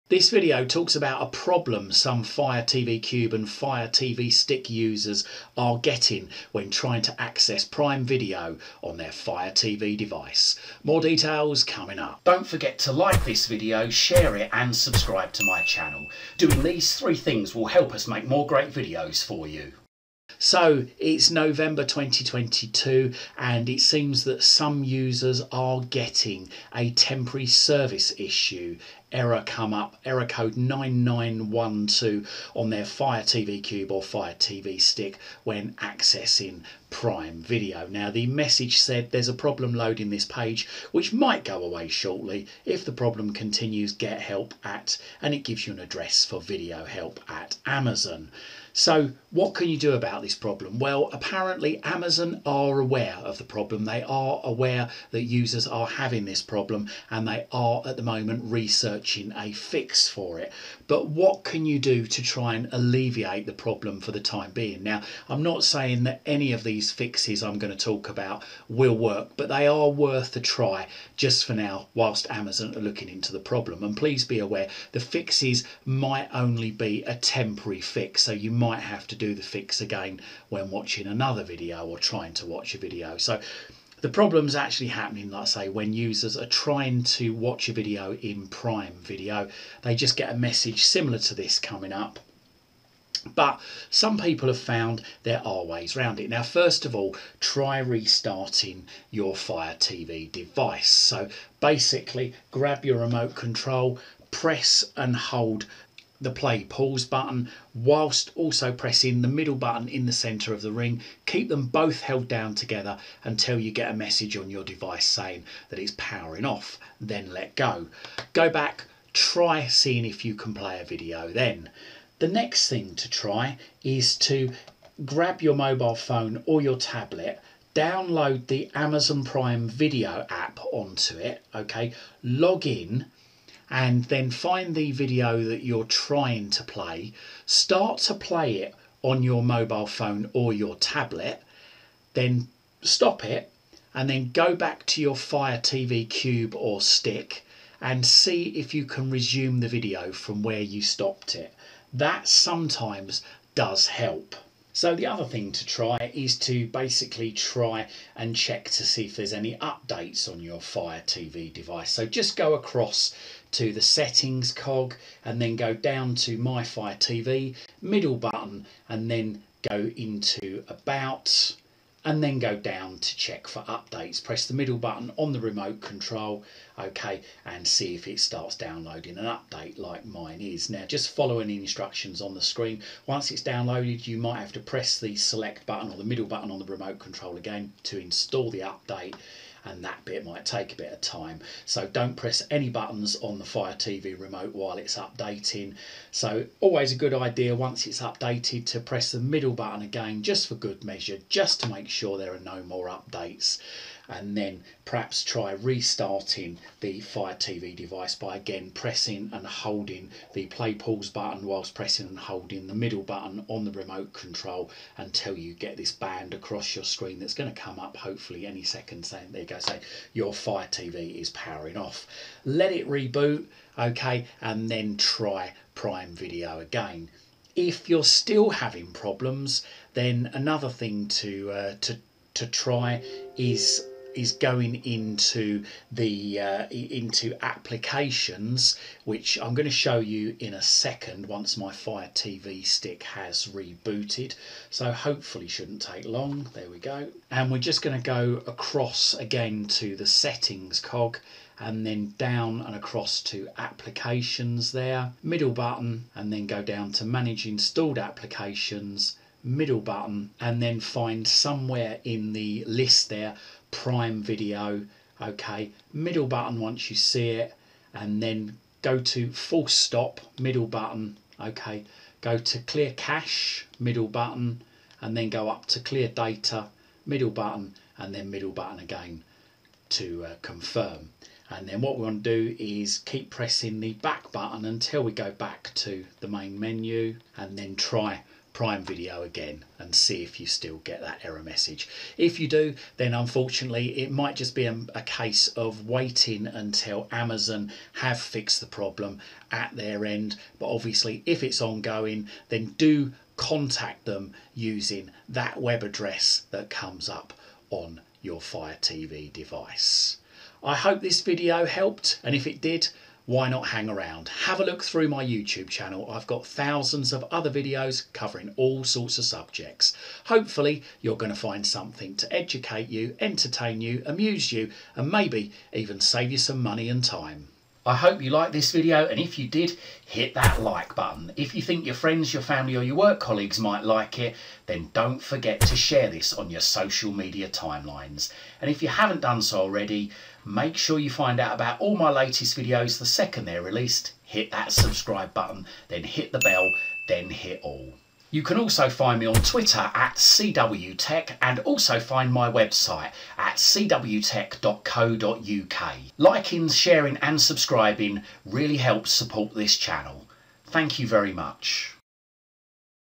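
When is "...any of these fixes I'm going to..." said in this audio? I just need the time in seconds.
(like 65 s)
66 s.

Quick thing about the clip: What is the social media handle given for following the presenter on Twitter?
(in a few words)
CWTek.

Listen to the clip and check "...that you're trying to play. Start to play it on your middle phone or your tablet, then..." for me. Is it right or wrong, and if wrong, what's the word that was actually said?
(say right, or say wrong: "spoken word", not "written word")
wrong: "mobile", not "middle".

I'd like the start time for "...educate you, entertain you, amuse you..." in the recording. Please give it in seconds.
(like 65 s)
322 s.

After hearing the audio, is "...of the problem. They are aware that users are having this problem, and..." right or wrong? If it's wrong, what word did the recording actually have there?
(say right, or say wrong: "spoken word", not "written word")
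right.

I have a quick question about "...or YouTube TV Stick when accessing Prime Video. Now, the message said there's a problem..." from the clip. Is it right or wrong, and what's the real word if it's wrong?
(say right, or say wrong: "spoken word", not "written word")
wrong: "Fire", not "YouTube".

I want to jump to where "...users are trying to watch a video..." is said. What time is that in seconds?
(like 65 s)
85 s.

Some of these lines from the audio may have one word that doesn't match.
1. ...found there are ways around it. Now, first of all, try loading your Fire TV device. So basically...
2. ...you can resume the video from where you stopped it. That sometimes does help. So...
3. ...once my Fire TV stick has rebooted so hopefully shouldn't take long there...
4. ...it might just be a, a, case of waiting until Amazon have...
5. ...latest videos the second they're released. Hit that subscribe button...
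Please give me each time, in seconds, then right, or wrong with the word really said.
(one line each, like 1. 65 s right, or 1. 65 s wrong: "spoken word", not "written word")
1. 94 s wrong: "restarting", not "loading"
2. 148 s right
3. 241 s right
4. 293 s right
5. 342 s right.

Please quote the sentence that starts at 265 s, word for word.
Okay, middle button once you see it, and then go to full stop, middle button.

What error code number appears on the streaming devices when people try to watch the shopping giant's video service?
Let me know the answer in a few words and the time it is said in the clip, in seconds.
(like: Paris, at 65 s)
9912, at 30 s.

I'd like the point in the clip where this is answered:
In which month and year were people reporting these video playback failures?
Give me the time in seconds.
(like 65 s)
21 s.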